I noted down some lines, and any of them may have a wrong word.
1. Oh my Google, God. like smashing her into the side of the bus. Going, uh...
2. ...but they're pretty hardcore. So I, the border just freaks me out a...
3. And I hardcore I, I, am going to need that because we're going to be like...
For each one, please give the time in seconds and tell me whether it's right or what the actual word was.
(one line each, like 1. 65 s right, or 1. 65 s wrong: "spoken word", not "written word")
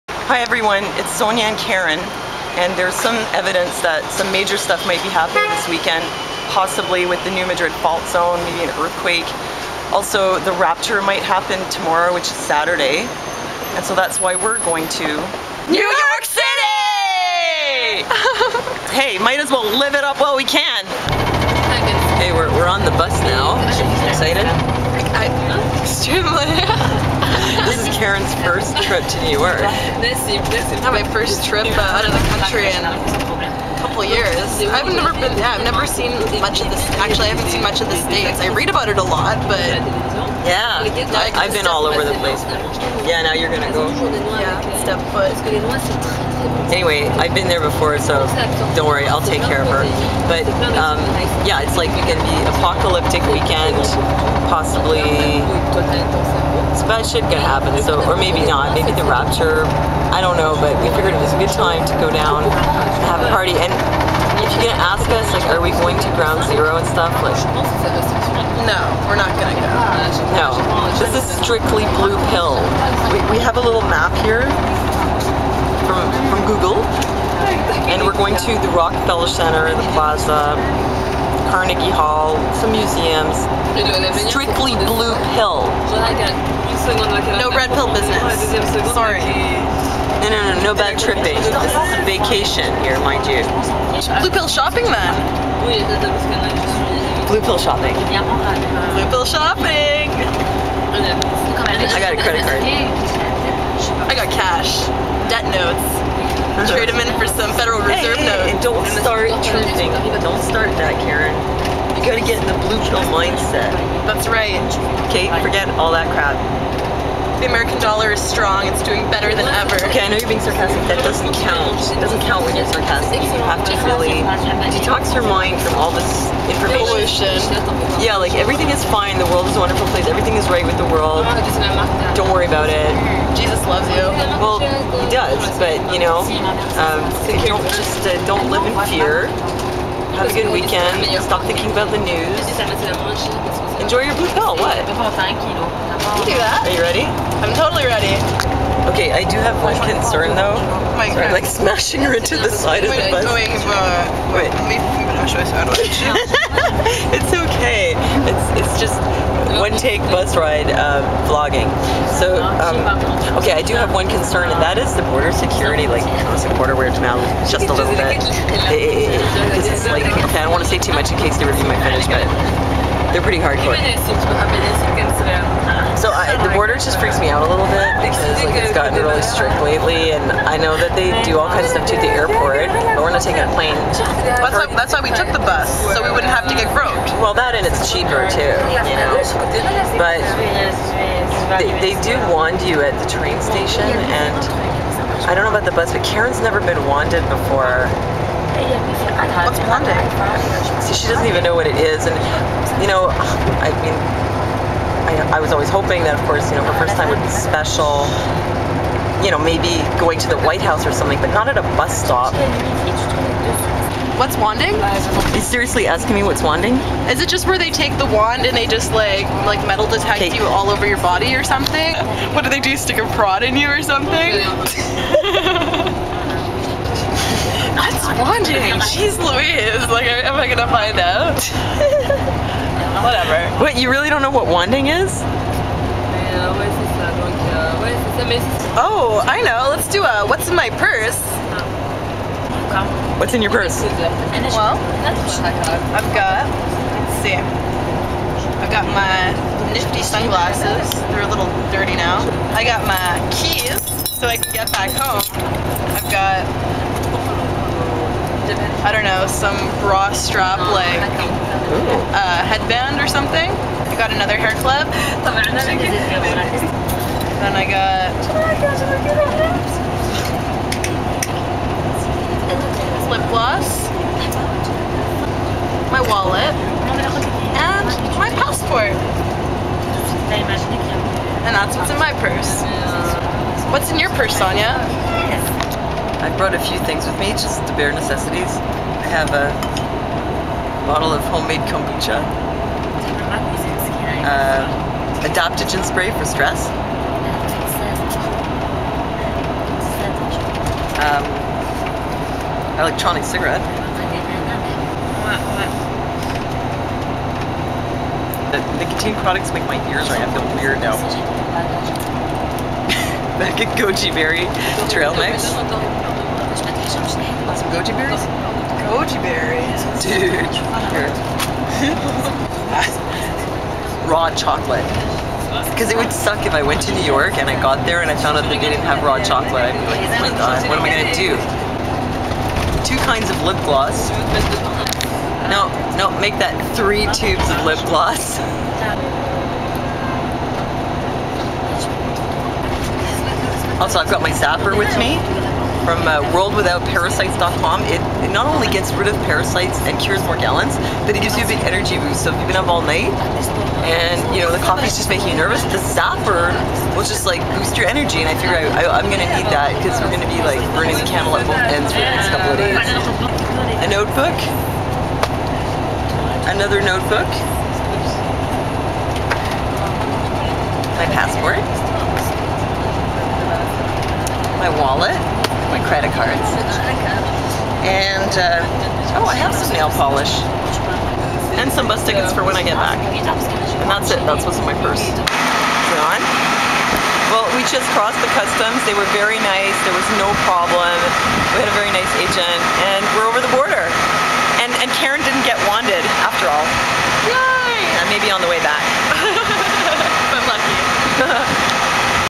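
1. 150 s wrong: "Sorry", not "Google"
2. 172 s right
3. 358 s wrong: "figure", not "hardcore".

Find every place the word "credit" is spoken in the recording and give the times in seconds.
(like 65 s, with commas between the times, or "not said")
102 s, 375 s.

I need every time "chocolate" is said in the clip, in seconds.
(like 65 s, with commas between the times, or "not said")
324 s, 329 s.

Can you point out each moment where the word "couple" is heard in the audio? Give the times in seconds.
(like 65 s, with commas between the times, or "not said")
33 s, 362 s.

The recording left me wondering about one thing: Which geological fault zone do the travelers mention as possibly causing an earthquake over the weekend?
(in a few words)
New Madrid Fault Zone.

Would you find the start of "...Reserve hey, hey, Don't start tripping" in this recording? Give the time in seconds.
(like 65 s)
107 s.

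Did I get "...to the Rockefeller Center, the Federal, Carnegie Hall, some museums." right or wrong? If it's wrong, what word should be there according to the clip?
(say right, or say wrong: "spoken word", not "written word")
wrong: "Plaza", not "Federal".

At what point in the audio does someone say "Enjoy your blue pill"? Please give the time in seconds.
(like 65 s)
143 s.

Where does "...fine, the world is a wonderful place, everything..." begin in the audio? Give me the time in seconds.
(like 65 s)
128 s.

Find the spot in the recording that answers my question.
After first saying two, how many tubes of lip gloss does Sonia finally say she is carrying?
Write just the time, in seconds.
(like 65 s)
336 s.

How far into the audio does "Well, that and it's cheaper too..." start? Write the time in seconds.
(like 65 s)
187 s.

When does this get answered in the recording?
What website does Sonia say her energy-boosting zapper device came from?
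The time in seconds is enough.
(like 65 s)
346 s.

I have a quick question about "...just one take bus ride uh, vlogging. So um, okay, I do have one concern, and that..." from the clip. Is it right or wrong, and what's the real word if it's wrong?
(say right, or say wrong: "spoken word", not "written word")
right.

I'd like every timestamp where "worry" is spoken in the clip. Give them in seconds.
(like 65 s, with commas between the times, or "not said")
48 s, 132 s.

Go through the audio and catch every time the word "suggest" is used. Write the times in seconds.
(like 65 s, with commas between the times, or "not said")
not said.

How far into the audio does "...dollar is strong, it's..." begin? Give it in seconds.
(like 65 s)
117 s.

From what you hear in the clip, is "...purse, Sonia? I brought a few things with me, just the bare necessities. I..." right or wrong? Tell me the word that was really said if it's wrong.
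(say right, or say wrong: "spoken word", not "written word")
right.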